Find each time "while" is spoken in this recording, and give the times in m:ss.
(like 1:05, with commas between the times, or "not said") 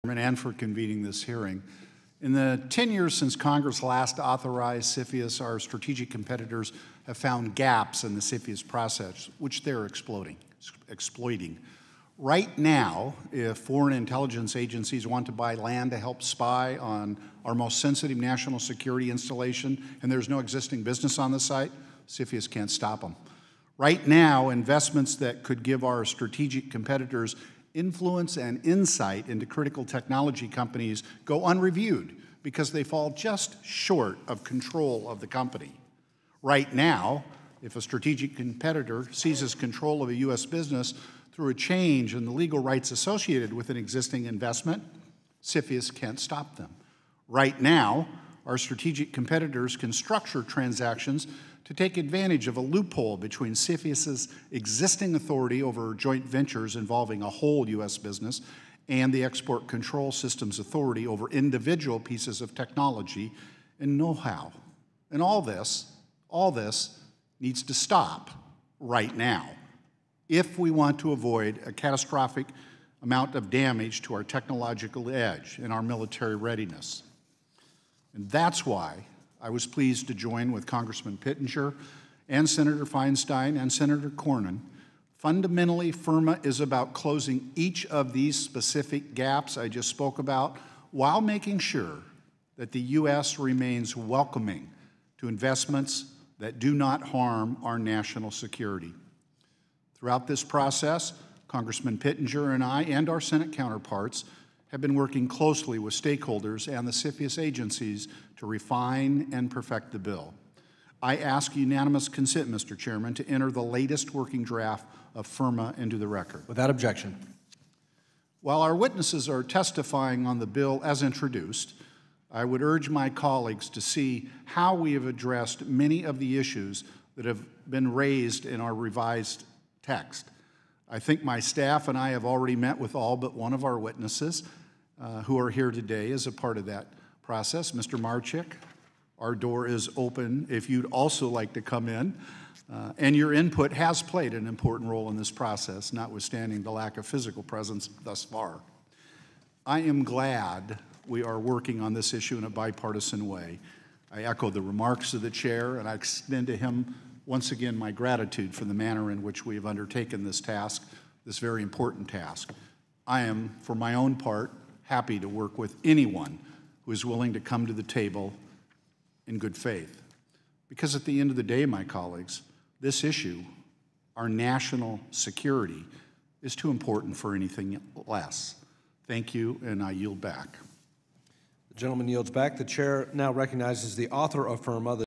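1:30, 1:58.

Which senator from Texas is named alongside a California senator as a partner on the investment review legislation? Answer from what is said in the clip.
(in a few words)
Senator Cornyn.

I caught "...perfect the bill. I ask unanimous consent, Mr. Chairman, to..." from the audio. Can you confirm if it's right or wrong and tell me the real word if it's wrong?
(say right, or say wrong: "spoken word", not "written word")
right.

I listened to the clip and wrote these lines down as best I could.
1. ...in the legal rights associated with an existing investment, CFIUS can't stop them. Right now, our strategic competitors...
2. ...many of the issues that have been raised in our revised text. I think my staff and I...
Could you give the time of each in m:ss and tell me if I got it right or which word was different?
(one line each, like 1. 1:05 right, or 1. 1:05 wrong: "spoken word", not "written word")
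1. 0:42 right
2. 2:05 right.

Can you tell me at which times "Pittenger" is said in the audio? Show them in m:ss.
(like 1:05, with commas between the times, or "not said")
1:21, 1:41.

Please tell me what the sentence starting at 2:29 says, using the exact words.
I am glad we are working on this issue in a bipartisan way.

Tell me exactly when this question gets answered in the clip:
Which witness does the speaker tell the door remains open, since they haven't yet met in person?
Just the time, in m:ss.
2:17.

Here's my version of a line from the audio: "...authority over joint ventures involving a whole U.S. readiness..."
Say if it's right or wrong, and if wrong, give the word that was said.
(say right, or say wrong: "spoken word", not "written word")
wrong: "business", not "readiness".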